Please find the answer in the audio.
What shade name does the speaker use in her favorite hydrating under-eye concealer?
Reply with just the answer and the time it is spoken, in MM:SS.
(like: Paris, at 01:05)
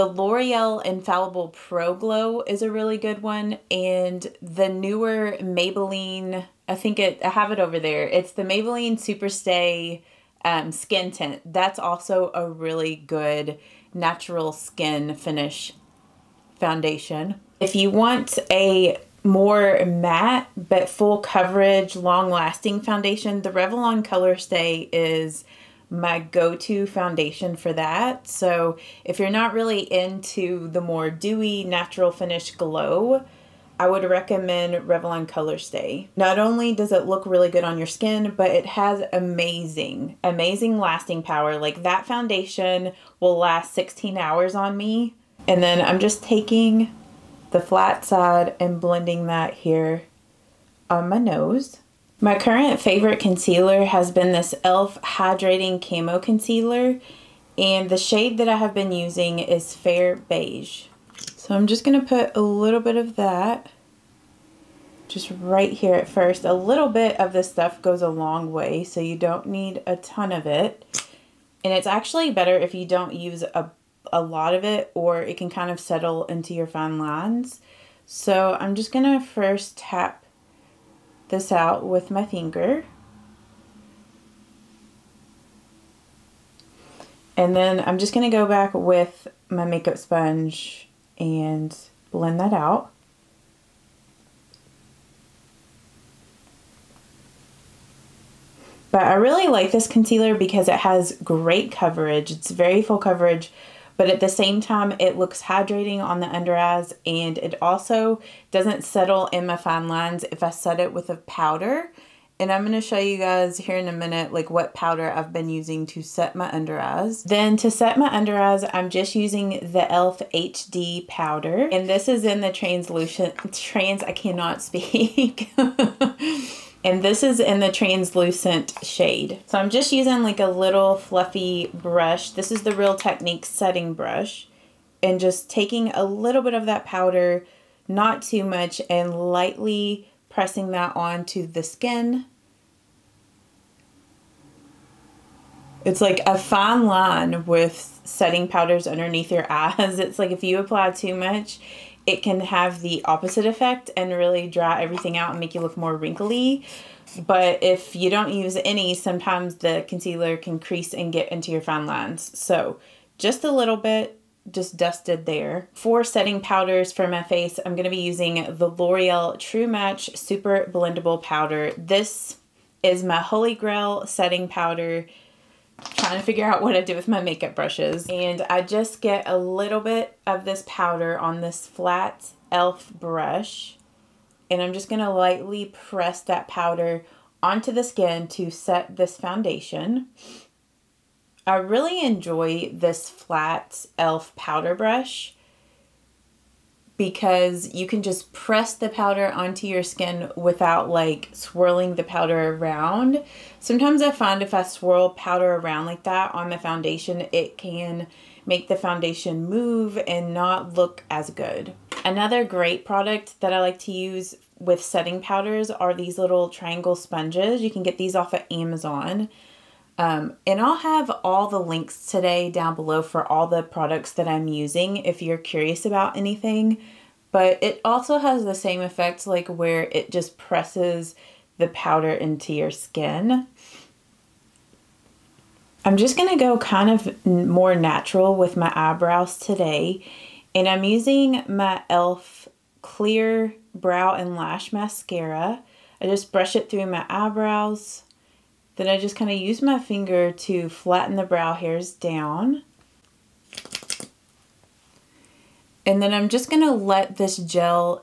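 Fair Beige, at 00:59.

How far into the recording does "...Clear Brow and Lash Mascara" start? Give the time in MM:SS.
04:02.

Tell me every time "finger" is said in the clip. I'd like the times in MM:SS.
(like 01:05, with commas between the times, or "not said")
01:22, 04:09.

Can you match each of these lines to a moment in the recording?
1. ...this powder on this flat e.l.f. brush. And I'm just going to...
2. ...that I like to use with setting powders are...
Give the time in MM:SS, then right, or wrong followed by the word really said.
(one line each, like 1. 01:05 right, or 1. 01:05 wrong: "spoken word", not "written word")
1. 03:00 right
2. 03:33 right.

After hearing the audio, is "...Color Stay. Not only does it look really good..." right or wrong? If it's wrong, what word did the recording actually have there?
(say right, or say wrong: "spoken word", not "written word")
right.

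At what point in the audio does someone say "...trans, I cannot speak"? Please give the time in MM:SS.
02:03.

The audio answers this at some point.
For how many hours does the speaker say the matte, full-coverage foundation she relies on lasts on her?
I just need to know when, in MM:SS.
00:43.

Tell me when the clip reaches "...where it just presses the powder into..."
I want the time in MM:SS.
03:49.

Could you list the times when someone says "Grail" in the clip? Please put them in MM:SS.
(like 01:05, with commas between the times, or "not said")
02:53.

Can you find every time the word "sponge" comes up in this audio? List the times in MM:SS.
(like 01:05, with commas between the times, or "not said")
01:29, 03:36.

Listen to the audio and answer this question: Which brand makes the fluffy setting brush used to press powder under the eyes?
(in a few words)
Real Techniques.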